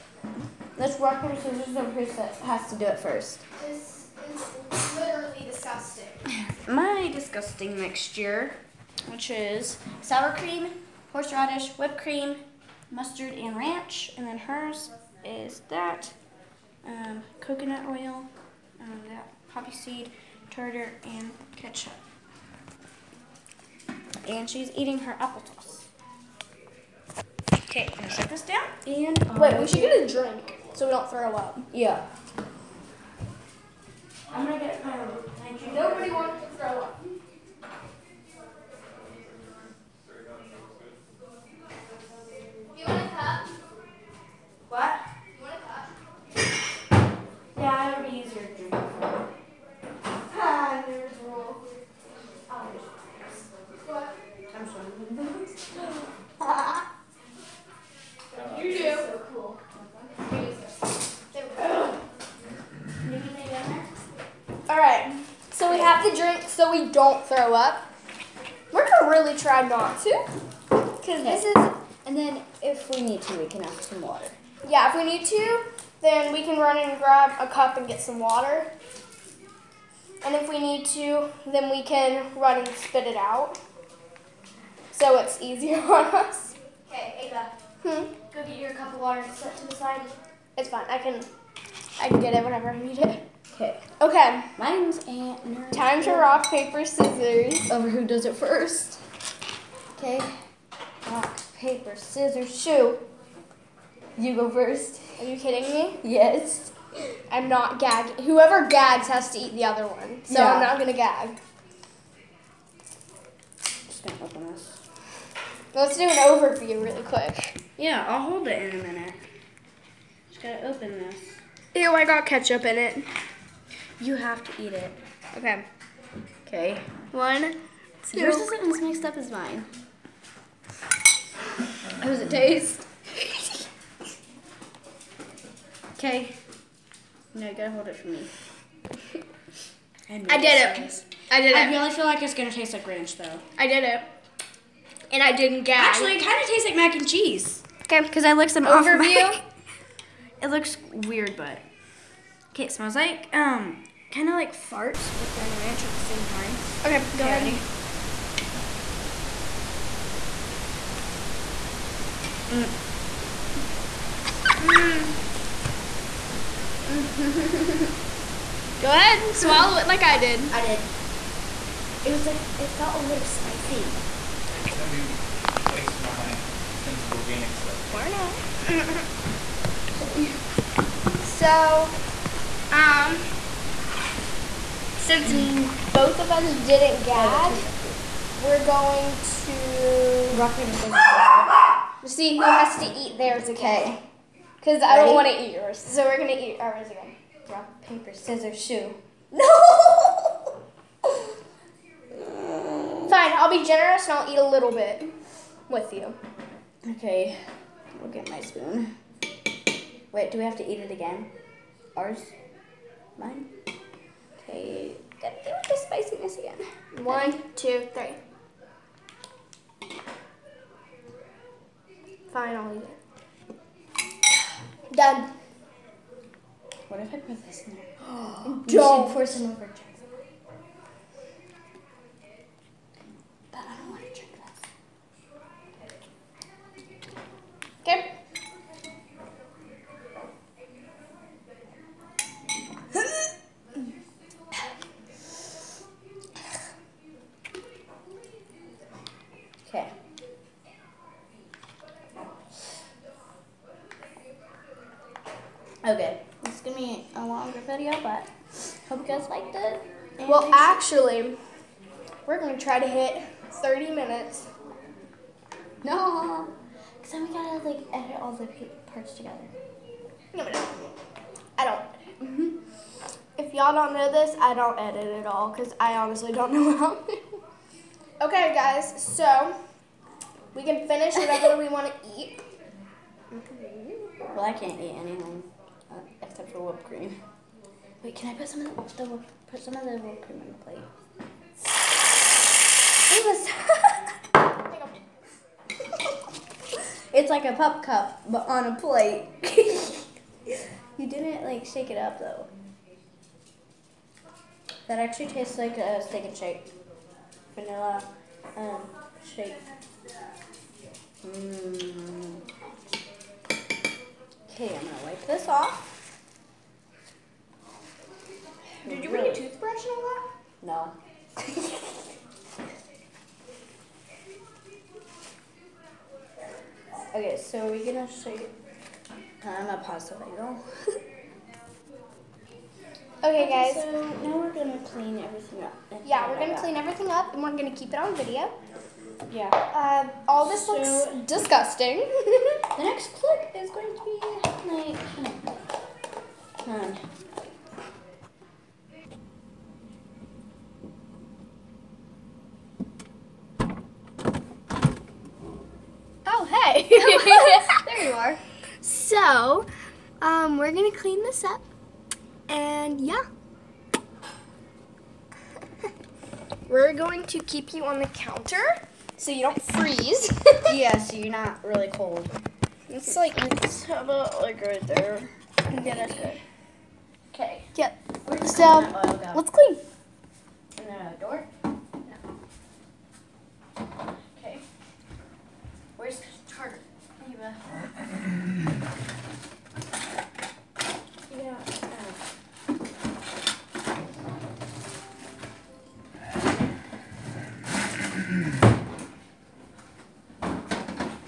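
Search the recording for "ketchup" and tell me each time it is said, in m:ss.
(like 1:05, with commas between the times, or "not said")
0:21, 2:02.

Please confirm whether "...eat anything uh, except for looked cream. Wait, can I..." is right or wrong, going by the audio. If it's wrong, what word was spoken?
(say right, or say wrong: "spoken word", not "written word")
wrong: "whipped", not "looked".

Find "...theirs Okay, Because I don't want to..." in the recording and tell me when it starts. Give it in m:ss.
3:13.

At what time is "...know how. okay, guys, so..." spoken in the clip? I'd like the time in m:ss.
4:36.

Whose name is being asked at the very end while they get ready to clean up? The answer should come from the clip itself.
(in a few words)
Carter.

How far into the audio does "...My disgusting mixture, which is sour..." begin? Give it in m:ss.
0:06.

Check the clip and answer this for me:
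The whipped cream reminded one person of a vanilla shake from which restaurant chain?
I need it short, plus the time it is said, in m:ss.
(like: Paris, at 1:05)
Steak and Shake, at 5:06.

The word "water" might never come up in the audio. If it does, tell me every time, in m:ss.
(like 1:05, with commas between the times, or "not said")
1:14, 1:18, 1:29.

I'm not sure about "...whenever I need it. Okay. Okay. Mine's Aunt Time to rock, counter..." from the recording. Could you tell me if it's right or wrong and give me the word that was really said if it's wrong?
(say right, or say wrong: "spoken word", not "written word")
wrong: "paper", not "counter".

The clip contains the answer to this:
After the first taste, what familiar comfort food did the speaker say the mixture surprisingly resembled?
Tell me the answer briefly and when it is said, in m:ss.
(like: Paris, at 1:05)
mac and cheese, at 2:26.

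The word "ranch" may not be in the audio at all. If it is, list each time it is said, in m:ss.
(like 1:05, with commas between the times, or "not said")
0:13, 2:22, 2:35.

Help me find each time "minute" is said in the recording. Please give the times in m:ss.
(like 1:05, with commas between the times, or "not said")
1:58.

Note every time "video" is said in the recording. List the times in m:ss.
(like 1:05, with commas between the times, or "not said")
5:30, 5:38.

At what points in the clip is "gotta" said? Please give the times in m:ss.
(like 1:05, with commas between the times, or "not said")
2:17, 3:35.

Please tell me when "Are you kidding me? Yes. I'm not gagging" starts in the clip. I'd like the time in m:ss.
1:45.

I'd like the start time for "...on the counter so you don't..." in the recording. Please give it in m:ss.
6:07.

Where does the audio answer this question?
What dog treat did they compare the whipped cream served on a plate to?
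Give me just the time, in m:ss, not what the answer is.
4:57.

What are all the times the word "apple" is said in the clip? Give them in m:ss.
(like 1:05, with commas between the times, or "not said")
0:25.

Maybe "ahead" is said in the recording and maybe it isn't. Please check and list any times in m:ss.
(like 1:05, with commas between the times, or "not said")
2:37, 2:48.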